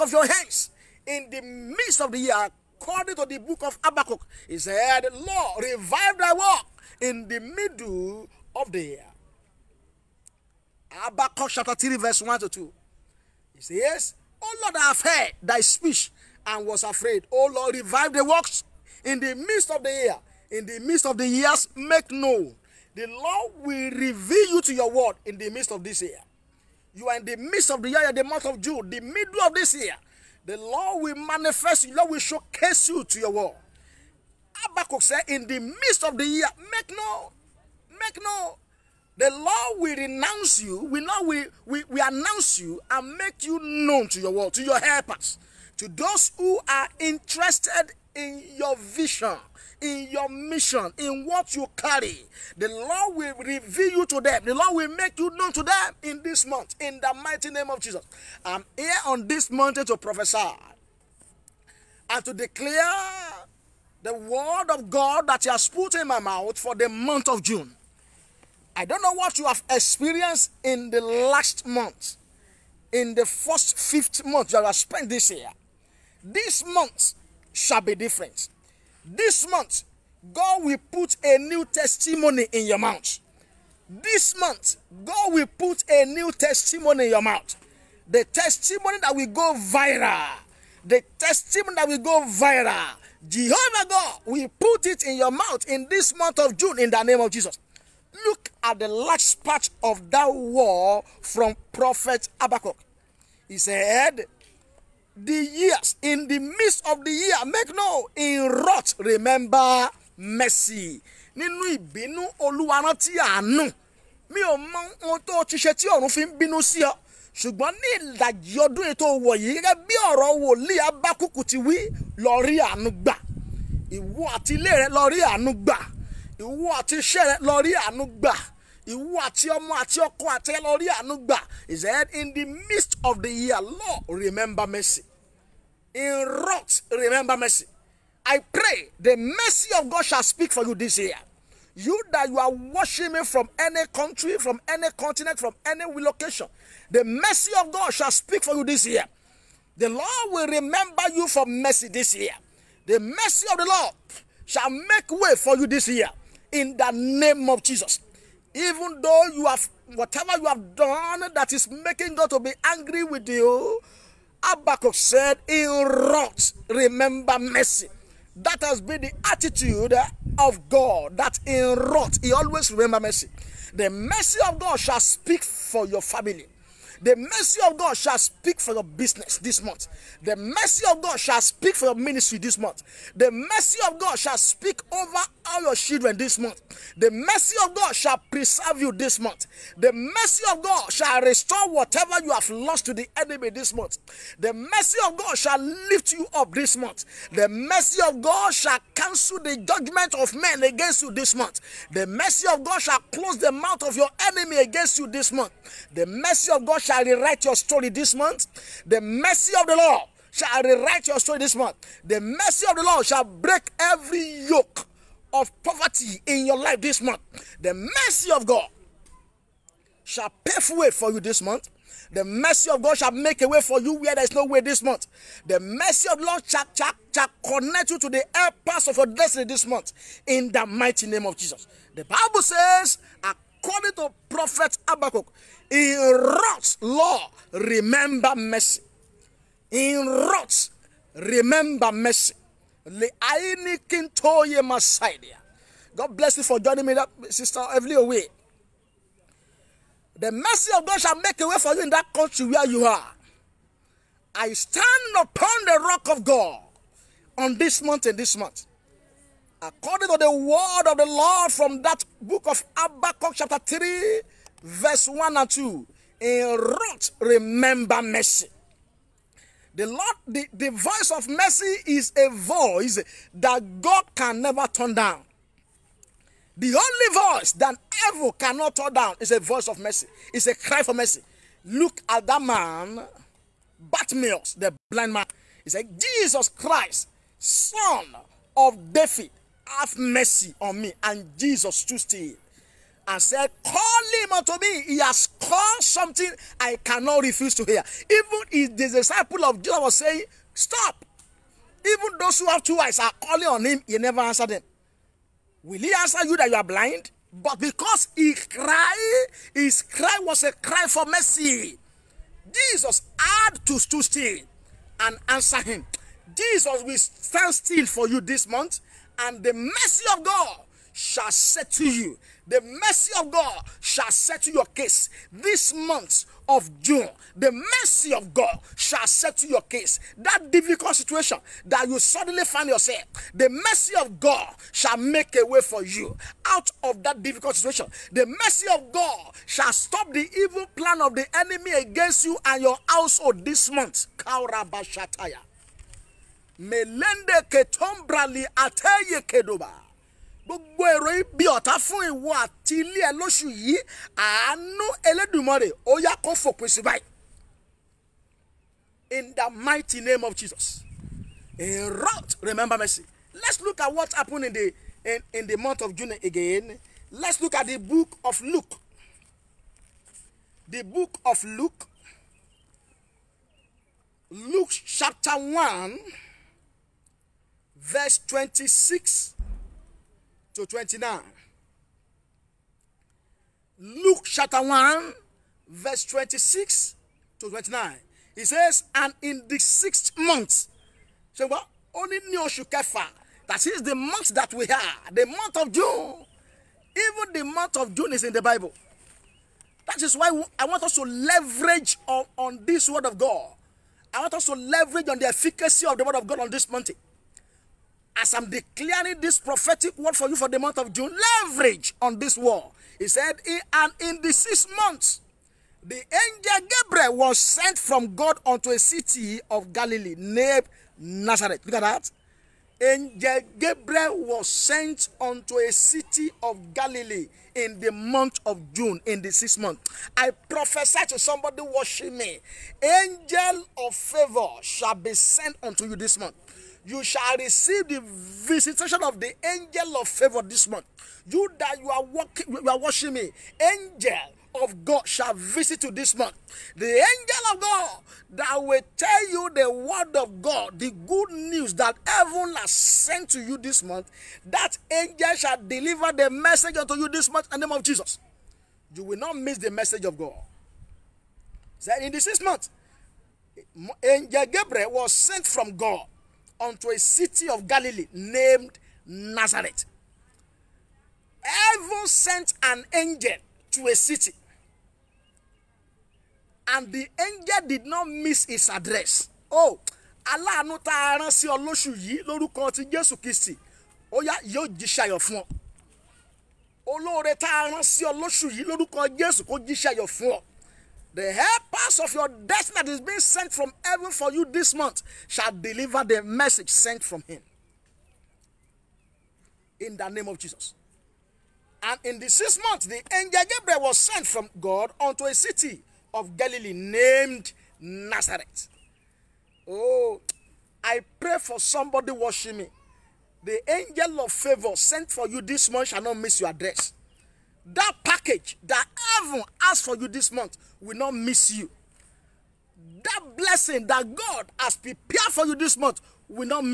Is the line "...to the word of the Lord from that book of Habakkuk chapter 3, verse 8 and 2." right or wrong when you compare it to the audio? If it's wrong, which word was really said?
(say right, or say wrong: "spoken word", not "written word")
wrong: "1", not "8".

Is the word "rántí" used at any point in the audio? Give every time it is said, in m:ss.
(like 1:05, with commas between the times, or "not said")
1:52.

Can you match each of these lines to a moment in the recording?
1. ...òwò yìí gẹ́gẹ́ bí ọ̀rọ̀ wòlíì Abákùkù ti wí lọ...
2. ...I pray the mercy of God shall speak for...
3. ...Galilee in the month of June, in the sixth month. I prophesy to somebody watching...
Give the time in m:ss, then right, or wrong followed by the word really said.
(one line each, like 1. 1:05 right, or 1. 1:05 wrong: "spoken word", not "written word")
1. 1:59 right
2. 2:18 right
3. 7:06 right.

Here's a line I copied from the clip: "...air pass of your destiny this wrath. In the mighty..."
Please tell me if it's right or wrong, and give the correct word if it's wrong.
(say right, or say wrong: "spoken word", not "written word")
wrong: "month", not "wrath".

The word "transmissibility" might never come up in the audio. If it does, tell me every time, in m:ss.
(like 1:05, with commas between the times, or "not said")
not said.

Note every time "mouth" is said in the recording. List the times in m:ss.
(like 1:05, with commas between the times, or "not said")
1:06, 1:22, 1:27, 1:35, 3:23.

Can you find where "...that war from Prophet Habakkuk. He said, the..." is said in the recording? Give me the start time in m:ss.
1:40.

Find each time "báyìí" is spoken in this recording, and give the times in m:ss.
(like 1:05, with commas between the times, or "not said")
5:56.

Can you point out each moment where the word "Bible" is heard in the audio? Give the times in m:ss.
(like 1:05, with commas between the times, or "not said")
3:52, 6:38.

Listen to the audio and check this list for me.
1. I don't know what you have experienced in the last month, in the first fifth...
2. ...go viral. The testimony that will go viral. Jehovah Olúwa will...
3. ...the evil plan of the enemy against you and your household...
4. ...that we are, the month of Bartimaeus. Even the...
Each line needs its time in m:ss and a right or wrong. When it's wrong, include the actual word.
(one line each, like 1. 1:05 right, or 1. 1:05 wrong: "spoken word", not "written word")
1. 1:08 right
2. 1:29 wrong: "God", not "Olúwa"
3. 5:40 right
4. 6:34 wrong: "June", not "Bartimaeus".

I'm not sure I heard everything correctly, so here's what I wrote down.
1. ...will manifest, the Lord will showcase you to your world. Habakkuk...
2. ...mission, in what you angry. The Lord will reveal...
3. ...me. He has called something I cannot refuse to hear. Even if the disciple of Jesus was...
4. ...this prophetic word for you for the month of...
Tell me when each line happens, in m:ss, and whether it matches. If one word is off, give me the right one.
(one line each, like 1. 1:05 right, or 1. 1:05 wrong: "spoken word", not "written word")
1. 0:31 right
2. 0:50 wrong: "carry", not "angry"
3. 4:54 right
4. 6:49 right.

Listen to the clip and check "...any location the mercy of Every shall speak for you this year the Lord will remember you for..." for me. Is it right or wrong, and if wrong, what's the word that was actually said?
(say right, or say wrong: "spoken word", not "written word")
wrong: "God", not "Every".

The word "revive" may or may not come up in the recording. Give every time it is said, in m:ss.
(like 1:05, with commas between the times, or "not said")
0:05, 0:17.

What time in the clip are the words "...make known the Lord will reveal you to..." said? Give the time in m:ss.
0:21.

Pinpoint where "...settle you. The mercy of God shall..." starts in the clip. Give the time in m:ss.
5:21.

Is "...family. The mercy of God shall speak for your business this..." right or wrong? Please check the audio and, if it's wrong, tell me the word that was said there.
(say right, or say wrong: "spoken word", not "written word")
right.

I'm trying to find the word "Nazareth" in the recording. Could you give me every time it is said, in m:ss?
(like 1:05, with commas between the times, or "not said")
7:00, 7:49, 8:27.